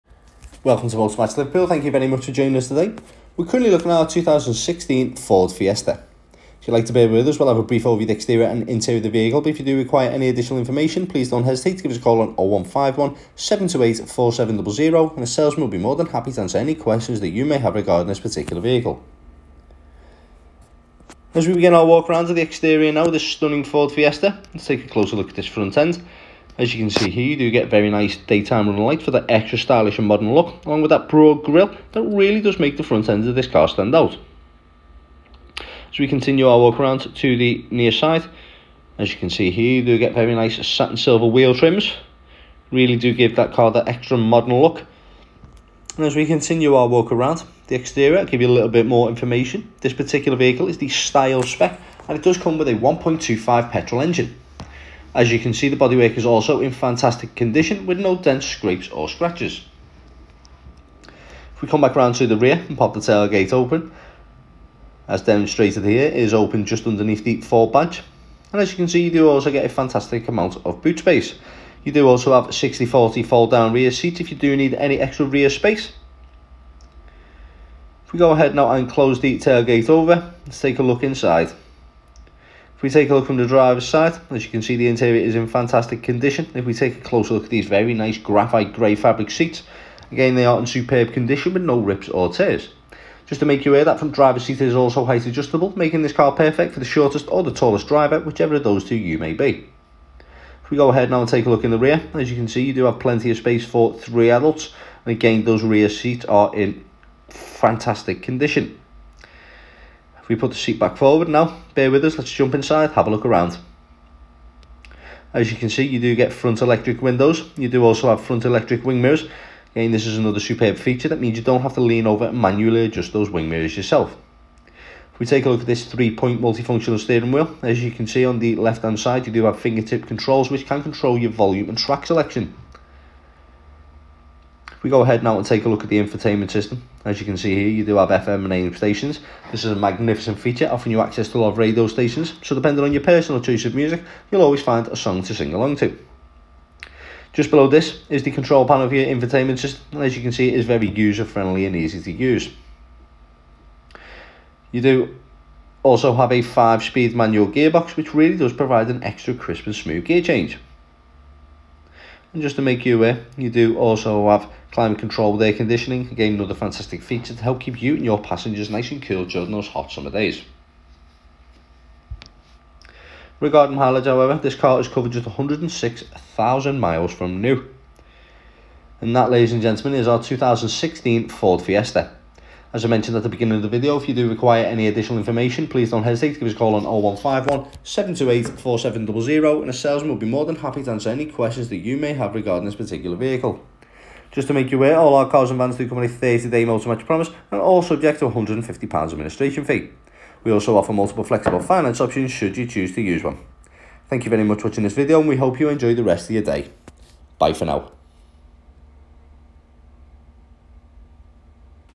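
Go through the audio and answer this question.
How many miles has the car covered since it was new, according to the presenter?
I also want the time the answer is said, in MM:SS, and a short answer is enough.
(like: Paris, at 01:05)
106,000 miles, at 02:55.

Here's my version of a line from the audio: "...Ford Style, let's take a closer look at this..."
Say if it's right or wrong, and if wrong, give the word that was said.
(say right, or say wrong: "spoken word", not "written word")
wrong: "Fiesta", not "Style".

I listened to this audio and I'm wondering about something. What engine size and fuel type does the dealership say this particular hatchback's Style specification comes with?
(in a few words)
1.25 petrol.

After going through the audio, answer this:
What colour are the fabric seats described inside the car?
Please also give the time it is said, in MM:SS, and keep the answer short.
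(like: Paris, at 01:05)
Graphite grey, at 01:28.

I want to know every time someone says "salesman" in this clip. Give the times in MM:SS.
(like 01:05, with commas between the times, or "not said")
00:15, 03:09.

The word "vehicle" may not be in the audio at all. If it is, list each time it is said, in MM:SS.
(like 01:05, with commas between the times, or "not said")
00:09, 00:18, 00:50, 03:13.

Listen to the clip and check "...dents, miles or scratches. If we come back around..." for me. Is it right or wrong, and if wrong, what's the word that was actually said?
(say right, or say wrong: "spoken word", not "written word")
wrong: "scrapes", not "miles".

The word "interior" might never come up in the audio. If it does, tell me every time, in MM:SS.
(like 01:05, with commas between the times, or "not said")
00:08, 01:24.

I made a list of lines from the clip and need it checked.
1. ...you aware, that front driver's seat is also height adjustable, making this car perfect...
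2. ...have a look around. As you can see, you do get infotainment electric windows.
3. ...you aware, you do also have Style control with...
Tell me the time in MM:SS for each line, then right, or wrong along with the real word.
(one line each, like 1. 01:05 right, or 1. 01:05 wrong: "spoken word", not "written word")
1. 01:33 right
2. 01:52 wrong: "front", not "infotainment"
3. 02:42 wrong: "Climate", not "Style".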